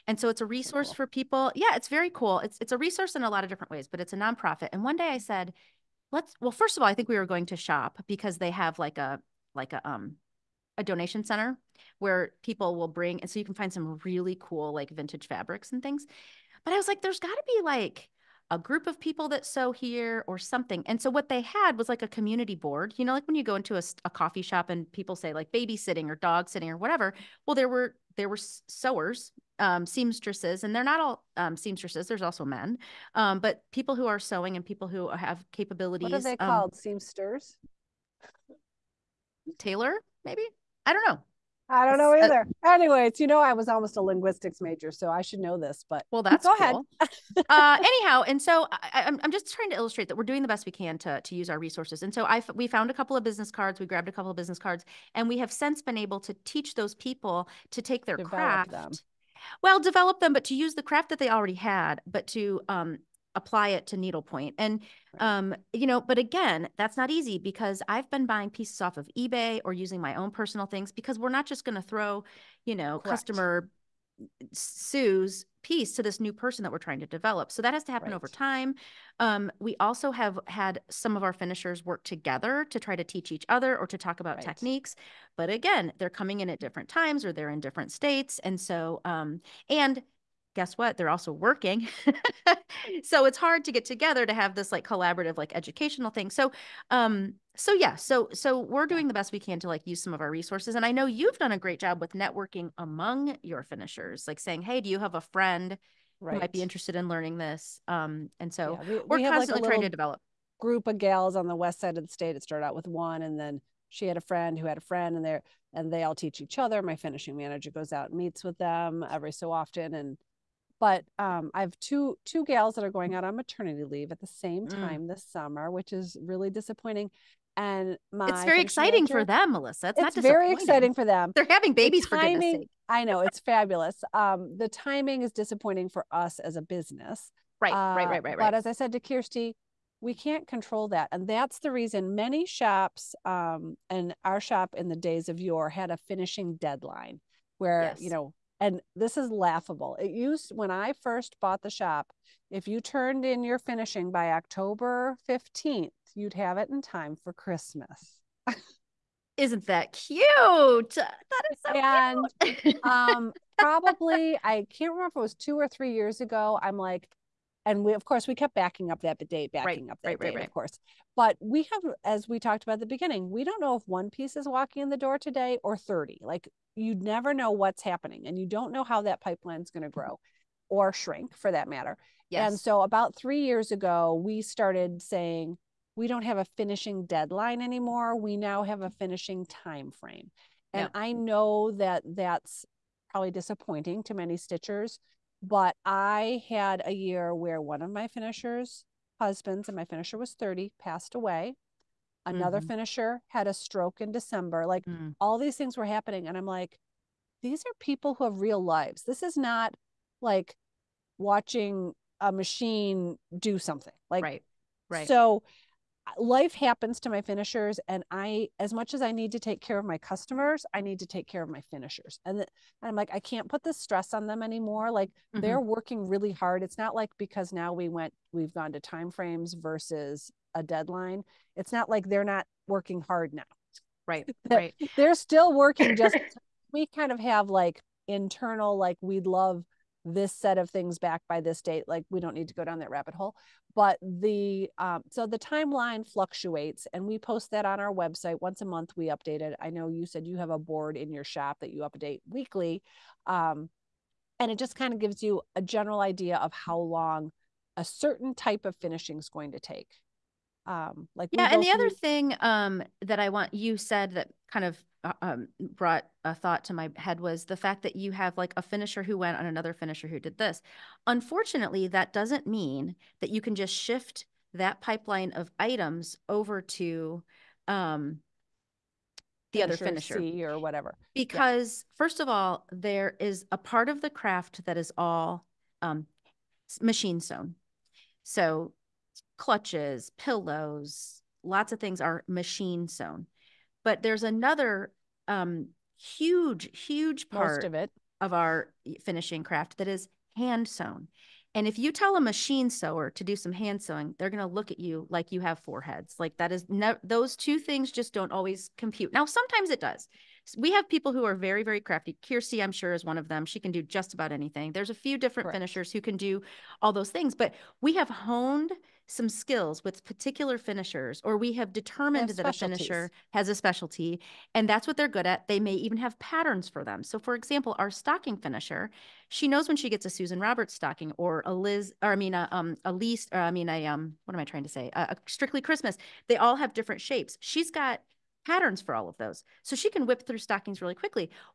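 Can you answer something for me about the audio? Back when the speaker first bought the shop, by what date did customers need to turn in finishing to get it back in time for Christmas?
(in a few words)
October 15th.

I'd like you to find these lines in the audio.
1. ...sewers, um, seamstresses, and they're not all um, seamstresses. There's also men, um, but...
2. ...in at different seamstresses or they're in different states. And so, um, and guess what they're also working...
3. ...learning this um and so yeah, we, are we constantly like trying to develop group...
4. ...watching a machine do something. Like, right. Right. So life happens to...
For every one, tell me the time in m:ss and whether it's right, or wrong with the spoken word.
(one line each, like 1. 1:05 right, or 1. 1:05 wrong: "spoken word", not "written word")
1. 0:28 right
2. 1:26 wrong: "times", not "seamstresses"
3. 1:47 right
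4. 3:31 right.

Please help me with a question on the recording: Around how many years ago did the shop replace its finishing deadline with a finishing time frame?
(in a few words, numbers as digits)
3 years.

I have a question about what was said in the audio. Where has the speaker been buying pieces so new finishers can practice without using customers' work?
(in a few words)
eBay.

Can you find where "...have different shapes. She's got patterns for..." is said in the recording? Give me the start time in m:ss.
5:36.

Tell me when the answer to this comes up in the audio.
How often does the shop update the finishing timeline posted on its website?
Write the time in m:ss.
4:08.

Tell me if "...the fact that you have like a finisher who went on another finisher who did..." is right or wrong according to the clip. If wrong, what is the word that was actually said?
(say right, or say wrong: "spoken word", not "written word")
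right.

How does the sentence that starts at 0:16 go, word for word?
But I was like, there's got to be like a group of people that sew here or something.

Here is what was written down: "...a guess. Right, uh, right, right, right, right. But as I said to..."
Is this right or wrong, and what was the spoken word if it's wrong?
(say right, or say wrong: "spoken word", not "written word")
wrong: "business", not "guess".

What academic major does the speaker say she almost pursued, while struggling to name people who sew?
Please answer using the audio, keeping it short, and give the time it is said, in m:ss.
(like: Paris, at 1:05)
Linguistics, at 0:44.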